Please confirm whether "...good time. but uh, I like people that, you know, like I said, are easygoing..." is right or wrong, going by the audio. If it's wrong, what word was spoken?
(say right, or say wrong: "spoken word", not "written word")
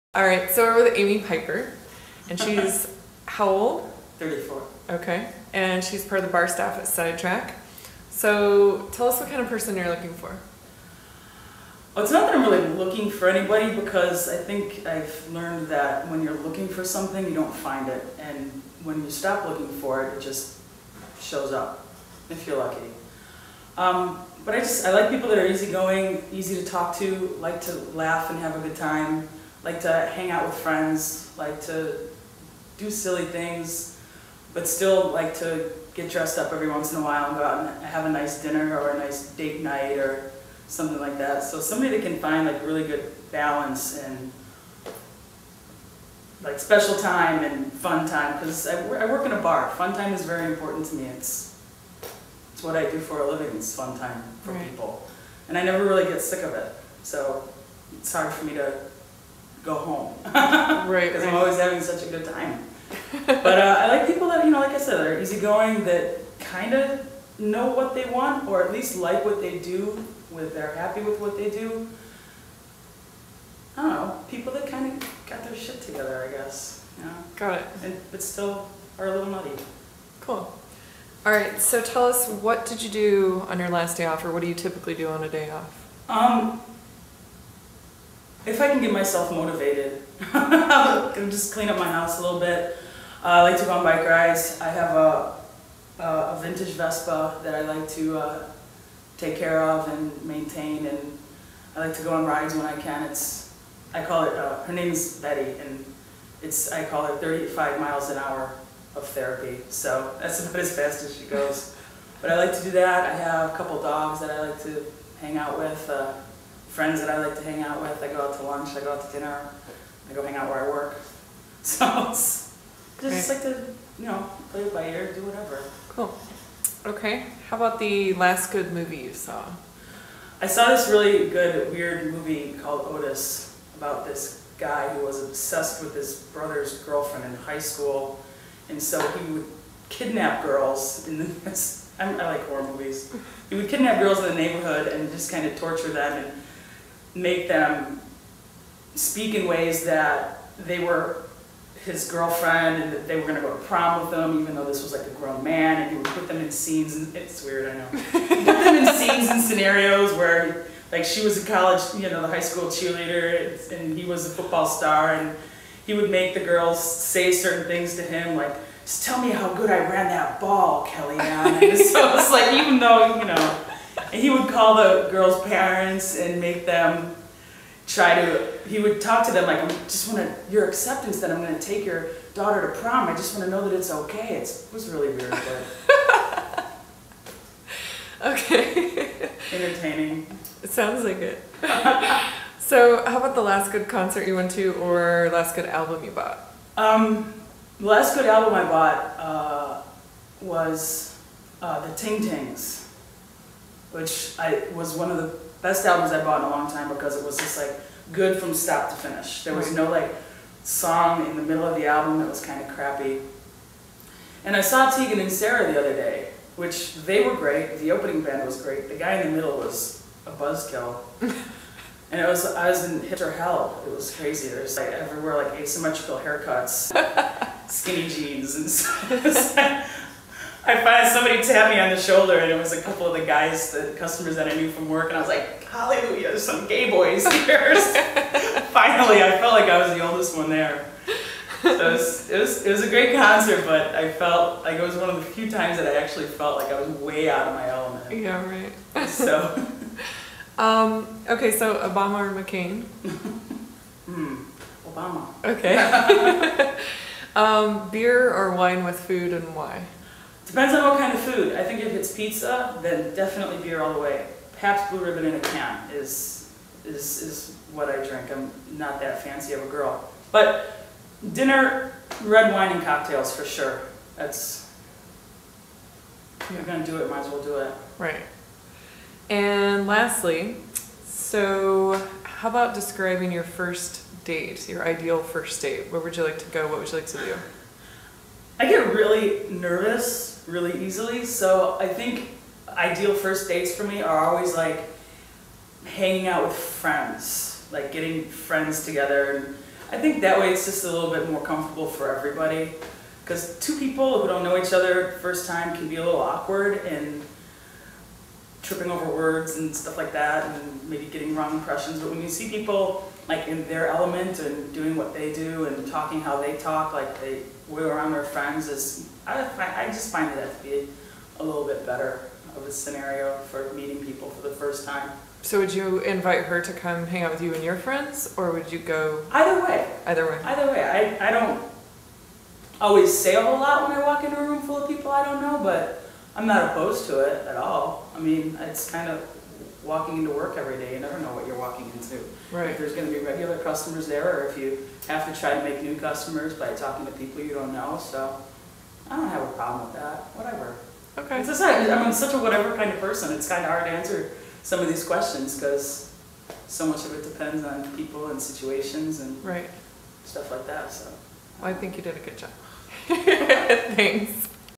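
right.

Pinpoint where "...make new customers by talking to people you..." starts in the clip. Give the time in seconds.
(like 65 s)
345 s.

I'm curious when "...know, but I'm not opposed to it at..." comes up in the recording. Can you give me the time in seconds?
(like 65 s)
335 s.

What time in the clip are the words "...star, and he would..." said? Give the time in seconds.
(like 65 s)
164 s.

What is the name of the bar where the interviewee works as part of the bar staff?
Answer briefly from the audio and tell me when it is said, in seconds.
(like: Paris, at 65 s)
Sidetrack, at 6 s.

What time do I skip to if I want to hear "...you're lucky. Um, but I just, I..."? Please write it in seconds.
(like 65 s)
22 s.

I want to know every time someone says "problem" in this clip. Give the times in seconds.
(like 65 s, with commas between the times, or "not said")
349 s.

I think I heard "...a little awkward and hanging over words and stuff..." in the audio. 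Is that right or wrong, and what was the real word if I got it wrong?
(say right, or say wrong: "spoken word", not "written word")
wrong: "tripping", not "hanging".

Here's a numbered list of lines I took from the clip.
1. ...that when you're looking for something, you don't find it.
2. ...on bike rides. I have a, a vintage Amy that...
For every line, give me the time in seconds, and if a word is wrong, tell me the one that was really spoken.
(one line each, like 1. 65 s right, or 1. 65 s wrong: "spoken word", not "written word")
1. 15 s right
2. 93 s wrong: "Vespa", not "Amy".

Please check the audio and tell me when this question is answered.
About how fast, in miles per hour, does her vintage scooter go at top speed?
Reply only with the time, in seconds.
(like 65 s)
107 s.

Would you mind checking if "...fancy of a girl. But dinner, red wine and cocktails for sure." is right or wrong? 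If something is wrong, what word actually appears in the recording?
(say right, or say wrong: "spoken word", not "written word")
right.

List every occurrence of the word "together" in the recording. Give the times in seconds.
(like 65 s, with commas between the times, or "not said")
75 s, 298 s.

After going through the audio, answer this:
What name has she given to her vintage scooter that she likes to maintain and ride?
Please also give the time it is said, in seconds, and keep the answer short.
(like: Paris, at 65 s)
Betty, at 105 s.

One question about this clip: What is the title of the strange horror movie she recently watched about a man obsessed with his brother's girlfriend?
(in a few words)
Otis.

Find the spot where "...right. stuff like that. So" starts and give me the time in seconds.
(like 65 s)
359 s.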